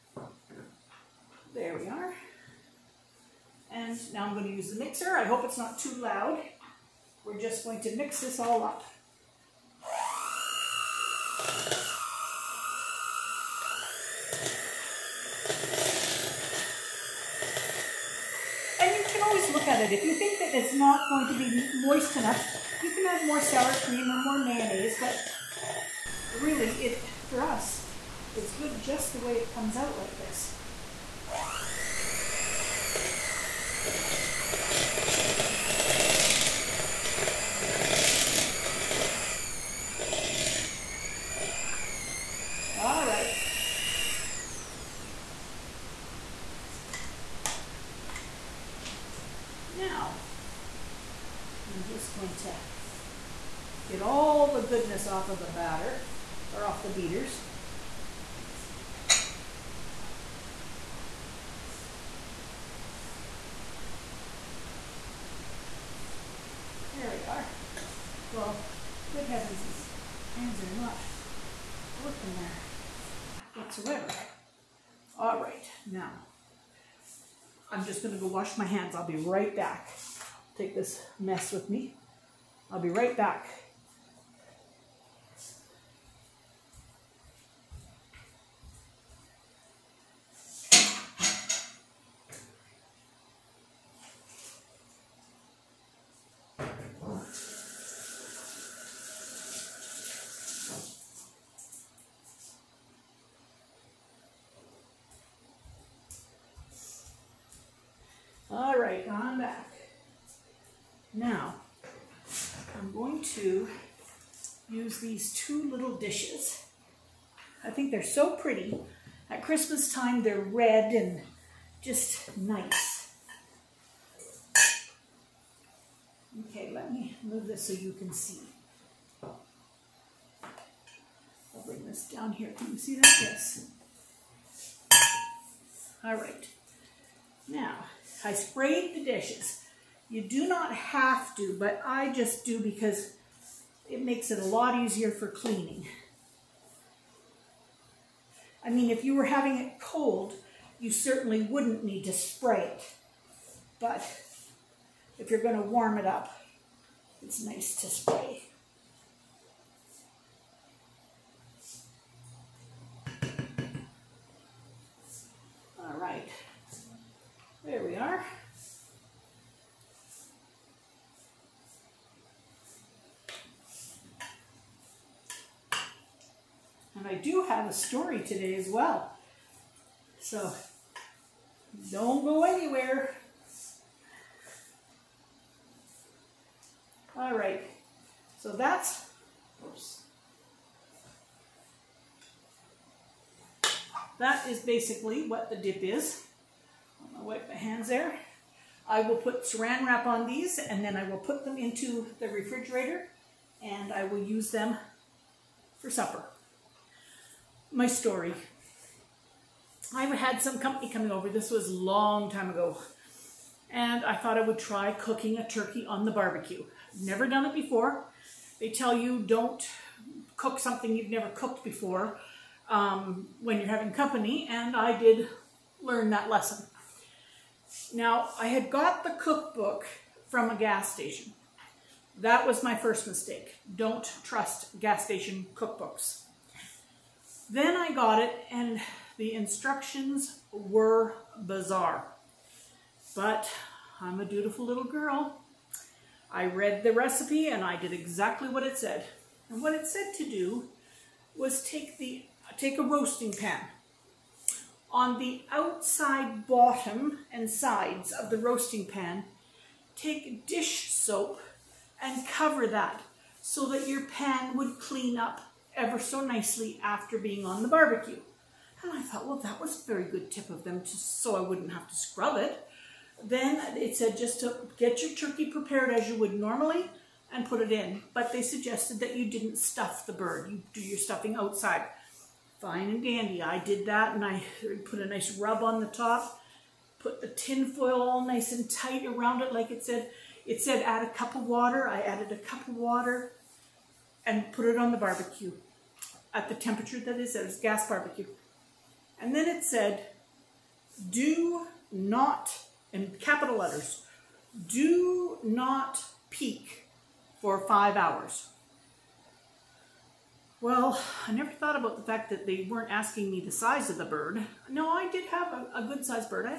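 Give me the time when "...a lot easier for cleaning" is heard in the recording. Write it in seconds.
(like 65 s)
144 s.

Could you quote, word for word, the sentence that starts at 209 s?
I had some company coming over.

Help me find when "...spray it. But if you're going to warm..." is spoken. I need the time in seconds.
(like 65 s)
152 s.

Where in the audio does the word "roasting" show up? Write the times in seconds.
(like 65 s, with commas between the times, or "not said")
252 s, 258 s.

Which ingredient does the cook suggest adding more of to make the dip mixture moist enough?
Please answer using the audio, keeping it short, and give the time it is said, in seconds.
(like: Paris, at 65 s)
sour cream, at 23 s.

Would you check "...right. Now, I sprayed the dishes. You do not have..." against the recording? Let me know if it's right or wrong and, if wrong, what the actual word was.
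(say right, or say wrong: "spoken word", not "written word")
right.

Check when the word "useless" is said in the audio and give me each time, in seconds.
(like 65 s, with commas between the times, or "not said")
not said.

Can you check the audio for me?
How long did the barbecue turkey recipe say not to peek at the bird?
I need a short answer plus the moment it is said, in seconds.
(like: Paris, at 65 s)
5 hours, at 307 s.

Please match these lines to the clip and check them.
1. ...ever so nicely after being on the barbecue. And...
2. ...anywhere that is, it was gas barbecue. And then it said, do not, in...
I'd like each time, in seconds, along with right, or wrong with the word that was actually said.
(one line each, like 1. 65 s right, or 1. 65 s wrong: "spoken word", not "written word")
1. 265 s right
2. 296 s wrong: "temperature", not "anywhere".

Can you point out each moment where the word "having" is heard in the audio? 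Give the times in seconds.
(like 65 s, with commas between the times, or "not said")
149 s, 223 s.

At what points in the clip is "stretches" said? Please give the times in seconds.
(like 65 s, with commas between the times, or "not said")
not said.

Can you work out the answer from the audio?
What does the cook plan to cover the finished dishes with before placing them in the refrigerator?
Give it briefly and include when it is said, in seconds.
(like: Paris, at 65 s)
saran wrap, at 199 s.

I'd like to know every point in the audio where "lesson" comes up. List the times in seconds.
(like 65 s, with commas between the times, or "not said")
226 s.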